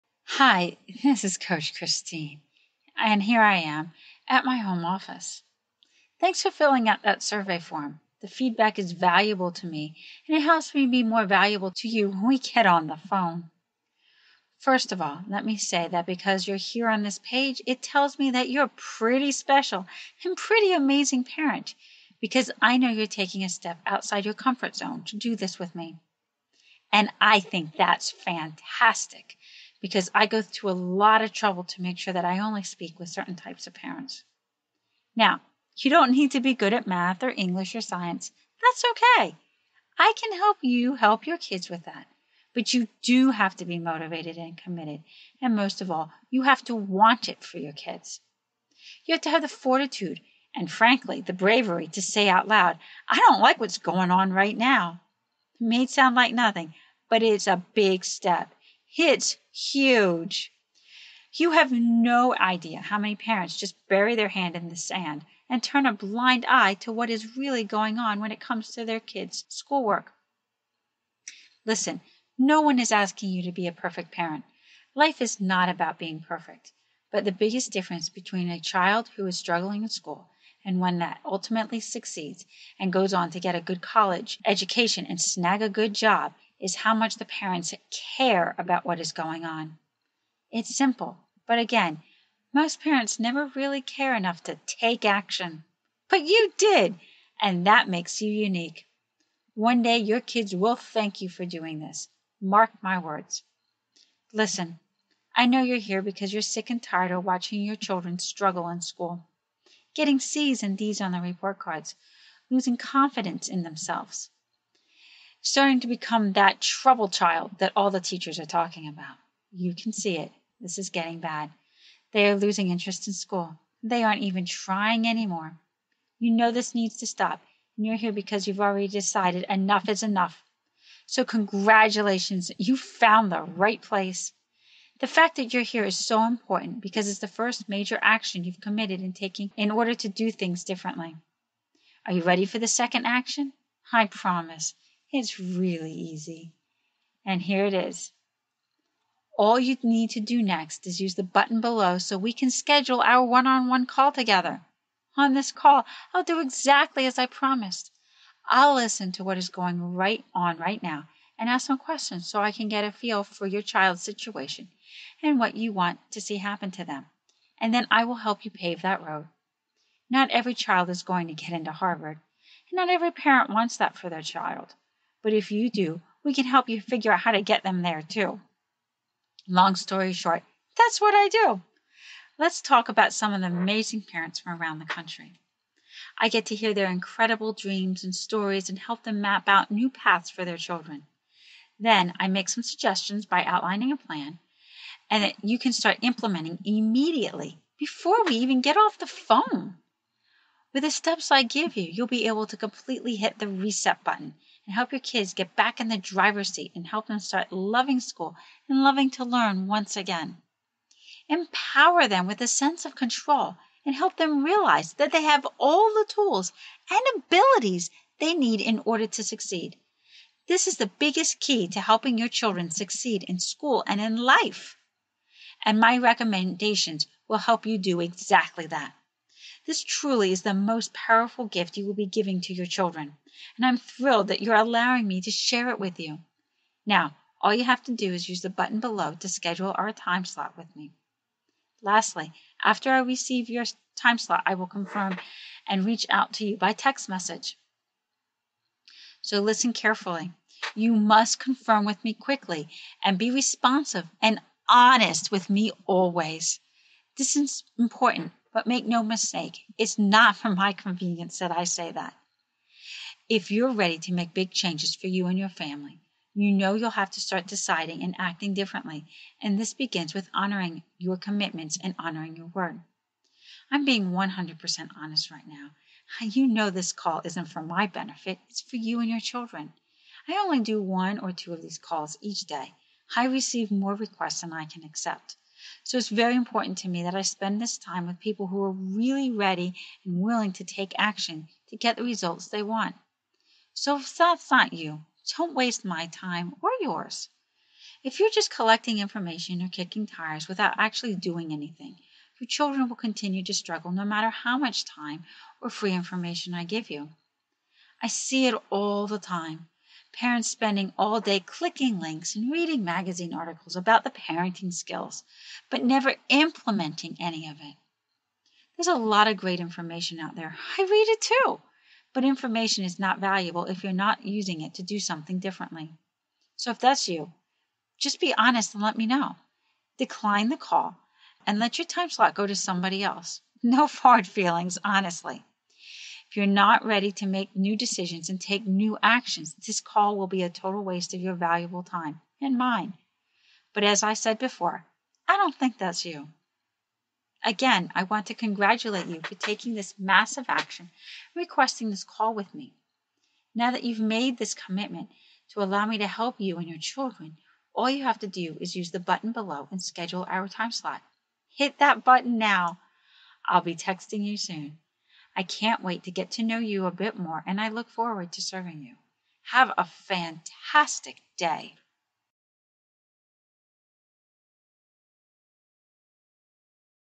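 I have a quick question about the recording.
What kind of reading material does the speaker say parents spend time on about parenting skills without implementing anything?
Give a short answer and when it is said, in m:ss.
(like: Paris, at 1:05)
magazine articles, at 5:12.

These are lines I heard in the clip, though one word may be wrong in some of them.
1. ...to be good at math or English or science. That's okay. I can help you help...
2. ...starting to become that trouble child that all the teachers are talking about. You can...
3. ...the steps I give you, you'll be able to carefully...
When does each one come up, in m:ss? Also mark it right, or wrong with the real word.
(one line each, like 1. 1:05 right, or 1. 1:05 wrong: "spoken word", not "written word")
1. 0:36 right
2. 1:55 right
3. 3:20 wrong: "completely", not "carefully".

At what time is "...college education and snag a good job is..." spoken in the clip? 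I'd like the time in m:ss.
1:23.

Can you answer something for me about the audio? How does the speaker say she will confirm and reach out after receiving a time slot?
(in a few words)
text message.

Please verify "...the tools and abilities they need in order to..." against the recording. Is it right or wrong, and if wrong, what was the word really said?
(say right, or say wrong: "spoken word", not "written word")
right.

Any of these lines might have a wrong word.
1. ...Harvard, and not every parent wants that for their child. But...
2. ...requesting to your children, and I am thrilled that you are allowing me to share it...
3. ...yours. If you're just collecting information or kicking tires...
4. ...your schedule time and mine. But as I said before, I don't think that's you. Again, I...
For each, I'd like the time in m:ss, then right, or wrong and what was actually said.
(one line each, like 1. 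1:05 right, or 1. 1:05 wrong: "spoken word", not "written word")
1. 2:51 right
2. 3:52 wrong: "giving", not "requesting"
3. 4:56 right
4. 5:41 wrong: "valuable", not "schedule".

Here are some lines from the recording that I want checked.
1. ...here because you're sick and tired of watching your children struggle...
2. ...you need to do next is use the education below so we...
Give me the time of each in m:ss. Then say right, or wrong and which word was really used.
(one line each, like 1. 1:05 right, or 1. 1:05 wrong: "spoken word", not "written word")
1. 1:45 right
2. 2:29 wrong: "button", not "education".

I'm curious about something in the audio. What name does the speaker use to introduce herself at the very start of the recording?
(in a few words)
Coach Christine.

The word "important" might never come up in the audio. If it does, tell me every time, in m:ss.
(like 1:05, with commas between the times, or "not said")
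2:16, 4:17, 4:46.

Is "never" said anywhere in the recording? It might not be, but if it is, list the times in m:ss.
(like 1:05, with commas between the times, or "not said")
1:33, 5:15.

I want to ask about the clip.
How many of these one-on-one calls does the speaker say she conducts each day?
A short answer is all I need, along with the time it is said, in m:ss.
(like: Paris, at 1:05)
1 or 2, at 4:40.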